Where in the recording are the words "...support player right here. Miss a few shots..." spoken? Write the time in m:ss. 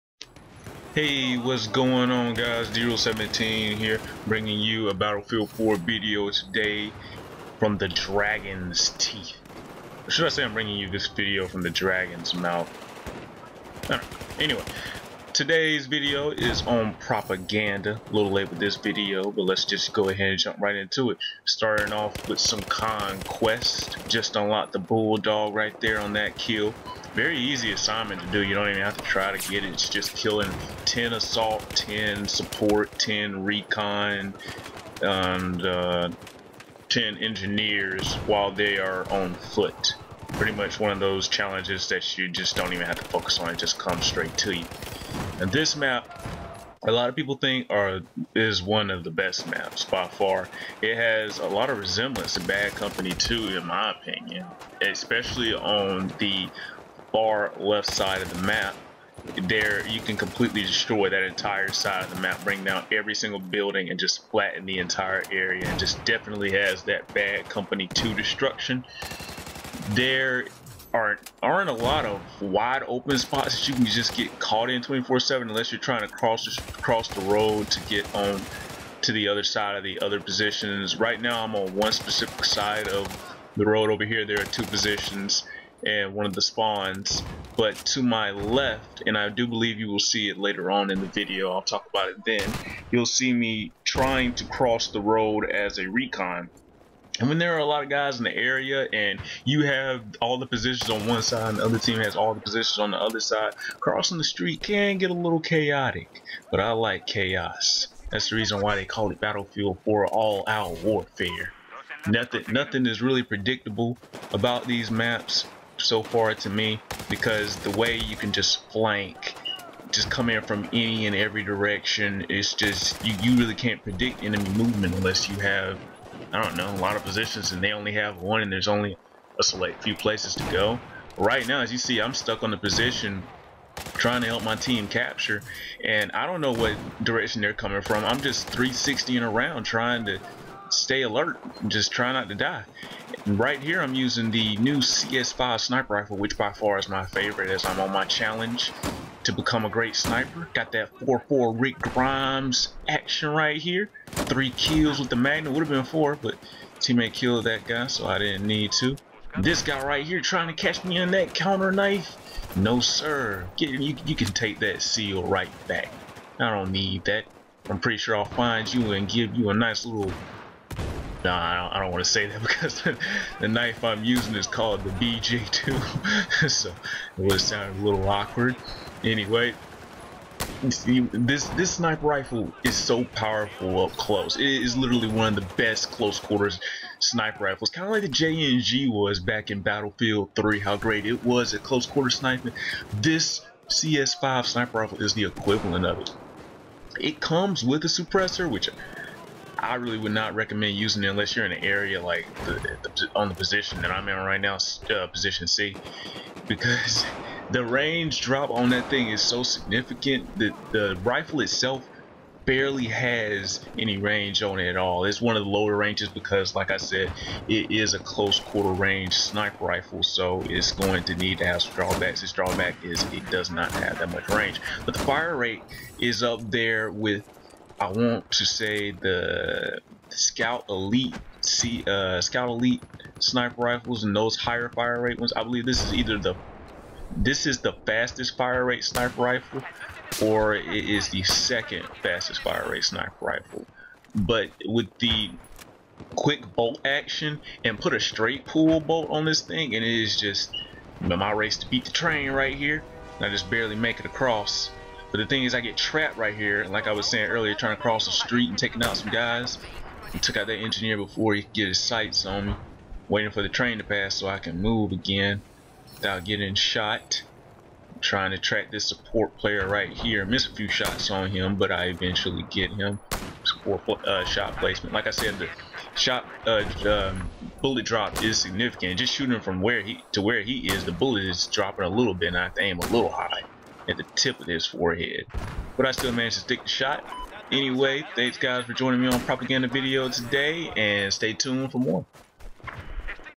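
4:28.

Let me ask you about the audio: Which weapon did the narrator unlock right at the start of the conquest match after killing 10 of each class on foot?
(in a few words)
Bulldog.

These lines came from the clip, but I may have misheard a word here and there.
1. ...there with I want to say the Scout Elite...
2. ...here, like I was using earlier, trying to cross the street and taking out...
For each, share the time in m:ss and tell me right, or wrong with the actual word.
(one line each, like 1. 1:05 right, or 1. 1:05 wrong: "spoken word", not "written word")
1. 3:46 right
2. 4:16 wrong: "saying", not "using".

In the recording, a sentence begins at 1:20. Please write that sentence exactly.
Right now, I'm on one specific side of the road over here.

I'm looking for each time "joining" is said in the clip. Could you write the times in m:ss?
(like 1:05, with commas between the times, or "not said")
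4:48.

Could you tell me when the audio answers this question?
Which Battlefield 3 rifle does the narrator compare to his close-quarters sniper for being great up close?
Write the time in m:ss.
3:08.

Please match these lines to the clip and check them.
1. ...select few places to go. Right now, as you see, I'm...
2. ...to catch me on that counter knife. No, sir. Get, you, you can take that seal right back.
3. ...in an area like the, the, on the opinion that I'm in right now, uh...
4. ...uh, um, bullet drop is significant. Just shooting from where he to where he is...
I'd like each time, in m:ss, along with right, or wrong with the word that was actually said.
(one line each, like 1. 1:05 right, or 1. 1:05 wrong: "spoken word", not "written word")
1. 2:09 right
2. 2:40 right
3. 3:21 wrong: "position", not "opinion"
4. 4:36 right.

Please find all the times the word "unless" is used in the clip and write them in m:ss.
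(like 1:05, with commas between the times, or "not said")
1:15, 2:04, 3:21.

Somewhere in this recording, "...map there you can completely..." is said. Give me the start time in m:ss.
0:58.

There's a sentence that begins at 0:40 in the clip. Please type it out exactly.
Pretty much one of those challenges that you just don't even have to focus on.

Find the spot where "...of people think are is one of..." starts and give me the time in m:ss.
0:47.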